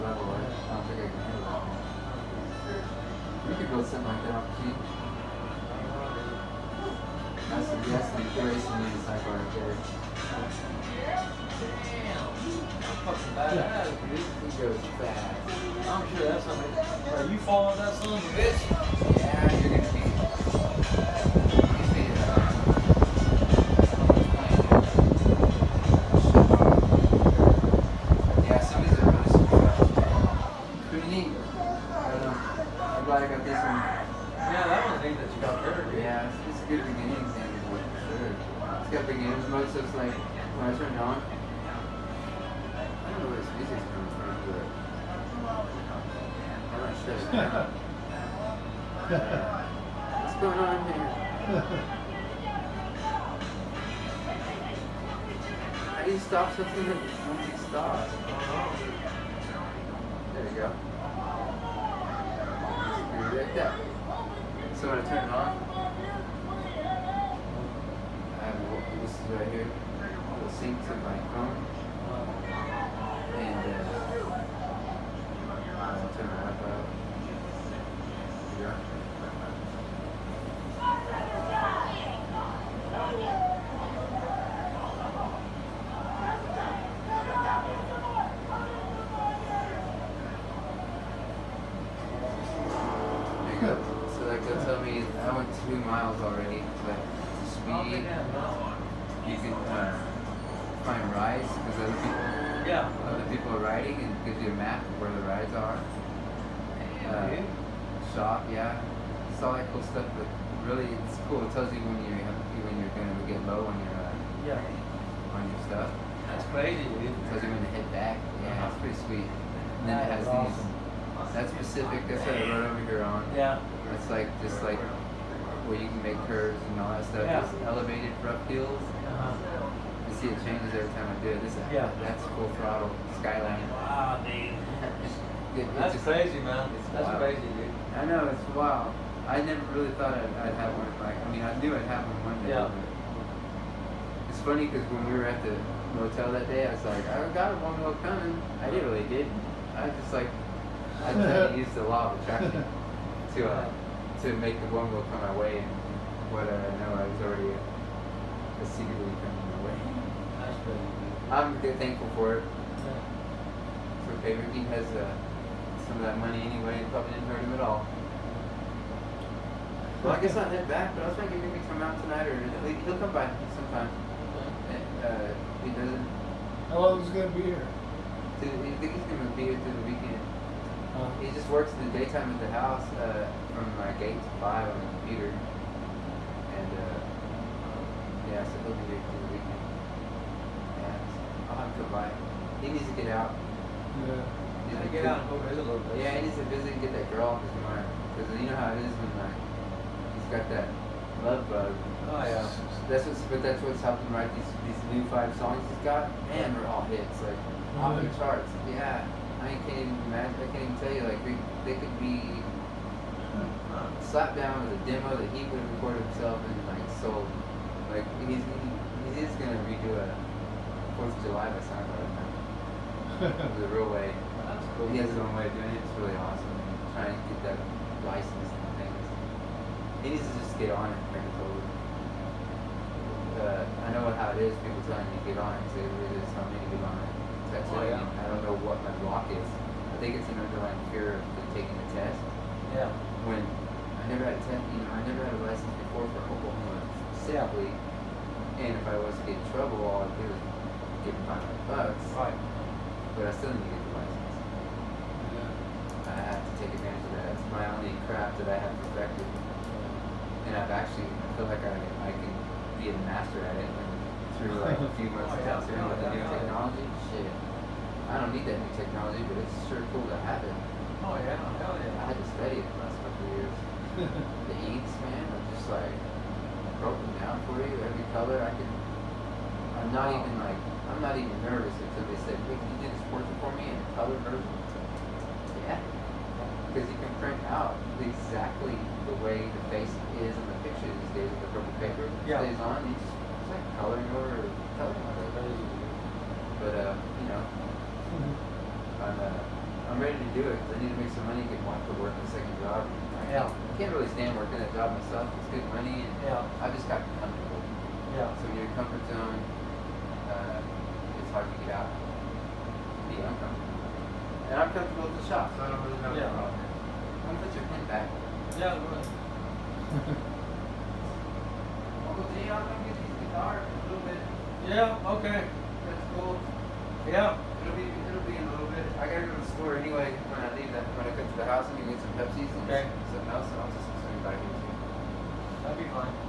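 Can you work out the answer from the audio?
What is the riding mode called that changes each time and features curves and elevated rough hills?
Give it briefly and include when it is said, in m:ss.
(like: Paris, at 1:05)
Full throttle skyline, at 2:12.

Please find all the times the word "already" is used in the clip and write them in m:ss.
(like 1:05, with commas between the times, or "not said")
1:36, 2:37.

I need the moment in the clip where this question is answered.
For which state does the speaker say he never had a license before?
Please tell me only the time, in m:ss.
4:06.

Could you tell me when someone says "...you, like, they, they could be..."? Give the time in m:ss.
3:30.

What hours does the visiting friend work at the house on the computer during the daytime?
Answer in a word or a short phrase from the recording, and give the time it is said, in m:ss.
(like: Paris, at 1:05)
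8 to 5, at 3:04.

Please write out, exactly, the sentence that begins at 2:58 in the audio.
Do you think he's going to be here through the weekend?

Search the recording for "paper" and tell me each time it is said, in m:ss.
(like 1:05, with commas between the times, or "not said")
4:51.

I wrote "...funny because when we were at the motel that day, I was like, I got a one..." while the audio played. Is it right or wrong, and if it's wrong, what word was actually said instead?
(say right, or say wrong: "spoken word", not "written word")
right.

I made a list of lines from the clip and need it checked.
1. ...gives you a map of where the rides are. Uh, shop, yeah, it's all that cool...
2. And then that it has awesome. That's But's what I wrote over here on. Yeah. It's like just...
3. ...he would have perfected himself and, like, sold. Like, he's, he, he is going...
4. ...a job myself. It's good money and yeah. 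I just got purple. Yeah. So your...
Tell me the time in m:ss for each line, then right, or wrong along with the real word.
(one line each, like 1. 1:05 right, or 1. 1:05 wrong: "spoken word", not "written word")
1. 1:44 right
2. 1:59 wrong: "That", not "But"
3. 3:35 wrong: "recorded", not "perfected"
4. 5:04 wrong: "comfortable", not "purple".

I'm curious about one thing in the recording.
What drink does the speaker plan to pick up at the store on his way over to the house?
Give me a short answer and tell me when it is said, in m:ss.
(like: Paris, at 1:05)
Pepsi, at 5:32.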